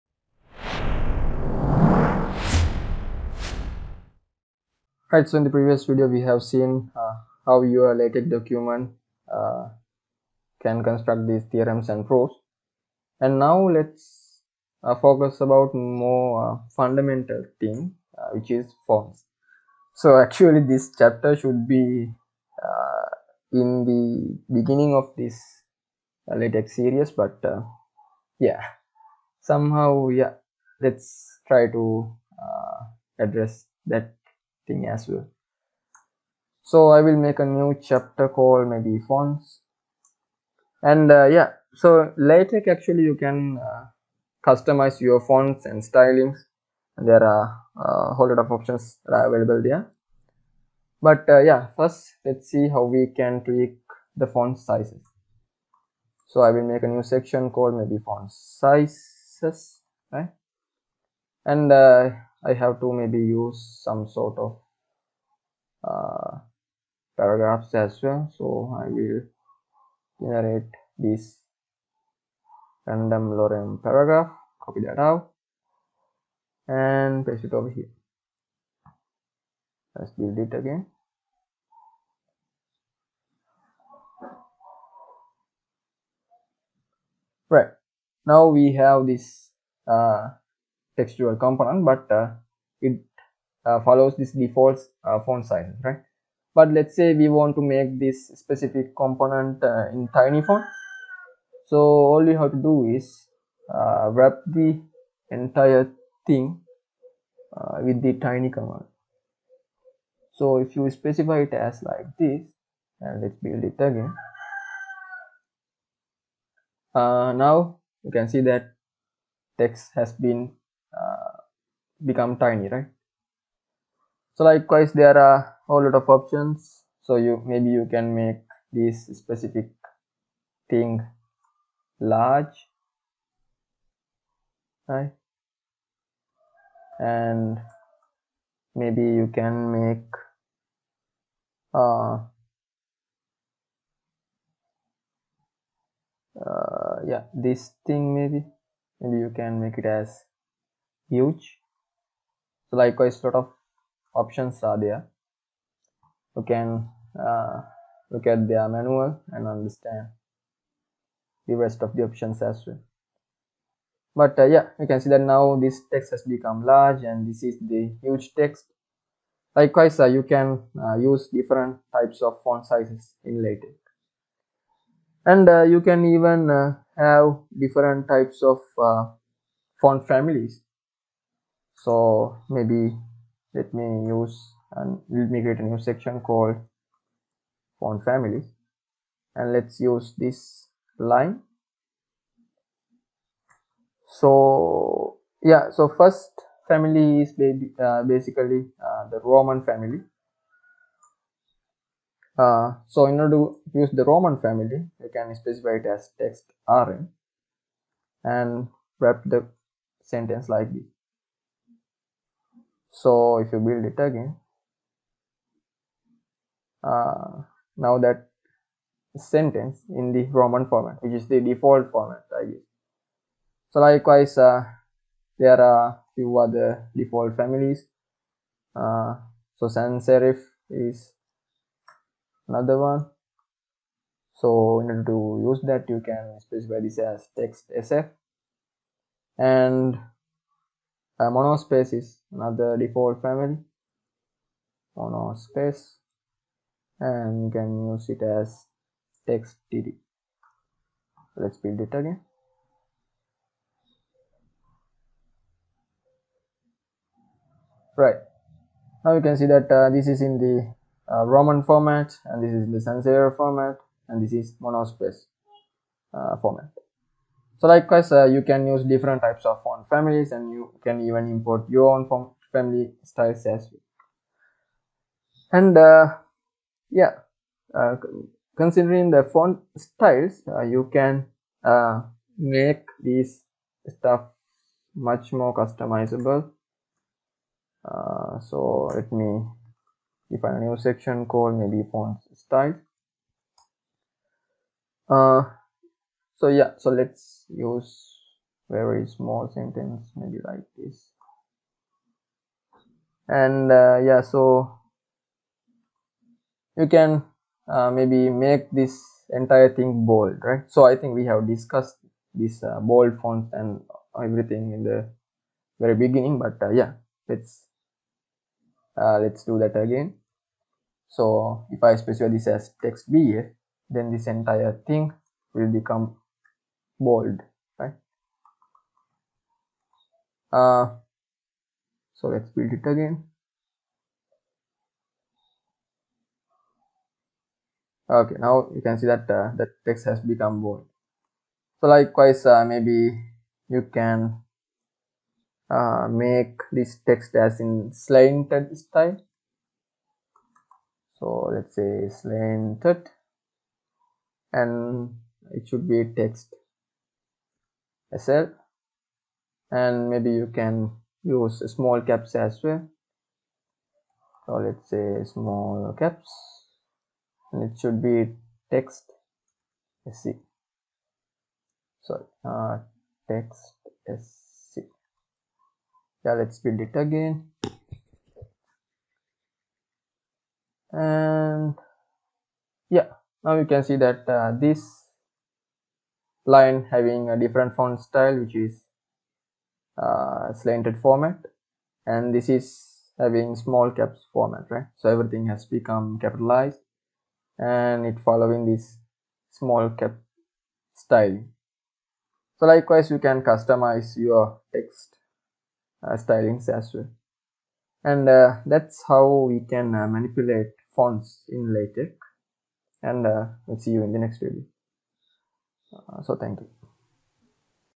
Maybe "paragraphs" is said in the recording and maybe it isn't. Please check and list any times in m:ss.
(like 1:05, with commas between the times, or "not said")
1:07, 1:13.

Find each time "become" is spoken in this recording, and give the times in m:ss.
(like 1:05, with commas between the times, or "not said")
2:02, 2:46, 5:25, 5:40, 6:35.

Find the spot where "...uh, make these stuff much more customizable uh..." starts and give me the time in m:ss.
4:41.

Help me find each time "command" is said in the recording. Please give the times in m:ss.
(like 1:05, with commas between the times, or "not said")
1:48.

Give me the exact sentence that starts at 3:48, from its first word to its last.
Uh, so sans serif is another one.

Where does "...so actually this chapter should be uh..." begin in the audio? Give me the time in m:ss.
0:19.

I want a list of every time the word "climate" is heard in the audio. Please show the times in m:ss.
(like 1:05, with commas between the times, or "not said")
not said.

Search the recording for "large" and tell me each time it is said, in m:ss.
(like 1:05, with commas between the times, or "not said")
2:12, 2:46.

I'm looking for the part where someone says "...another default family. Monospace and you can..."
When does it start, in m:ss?
4:02.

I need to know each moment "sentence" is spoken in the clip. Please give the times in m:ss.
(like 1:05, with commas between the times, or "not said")
3:30, 3:39, 4:59.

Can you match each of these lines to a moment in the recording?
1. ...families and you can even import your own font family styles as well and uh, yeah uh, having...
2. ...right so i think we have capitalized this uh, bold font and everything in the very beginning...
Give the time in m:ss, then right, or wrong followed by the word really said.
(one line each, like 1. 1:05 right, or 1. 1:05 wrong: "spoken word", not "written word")
1. 4:29 wrong: "considering", not "having"
2. 5:10 wrong: "discussed", not "capitalized".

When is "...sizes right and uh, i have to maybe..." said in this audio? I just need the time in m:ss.
0:58.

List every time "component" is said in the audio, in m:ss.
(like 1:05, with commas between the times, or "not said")
1:31, 1:38.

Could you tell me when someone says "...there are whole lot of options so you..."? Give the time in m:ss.
2:04.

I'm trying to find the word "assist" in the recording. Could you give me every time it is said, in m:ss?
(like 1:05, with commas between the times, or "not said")
not said.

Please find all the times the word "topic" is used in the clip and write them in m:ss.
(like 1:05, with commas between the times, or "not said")
not said.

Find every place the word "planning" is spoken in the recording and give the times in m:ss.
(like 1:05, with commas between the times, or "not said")
not said.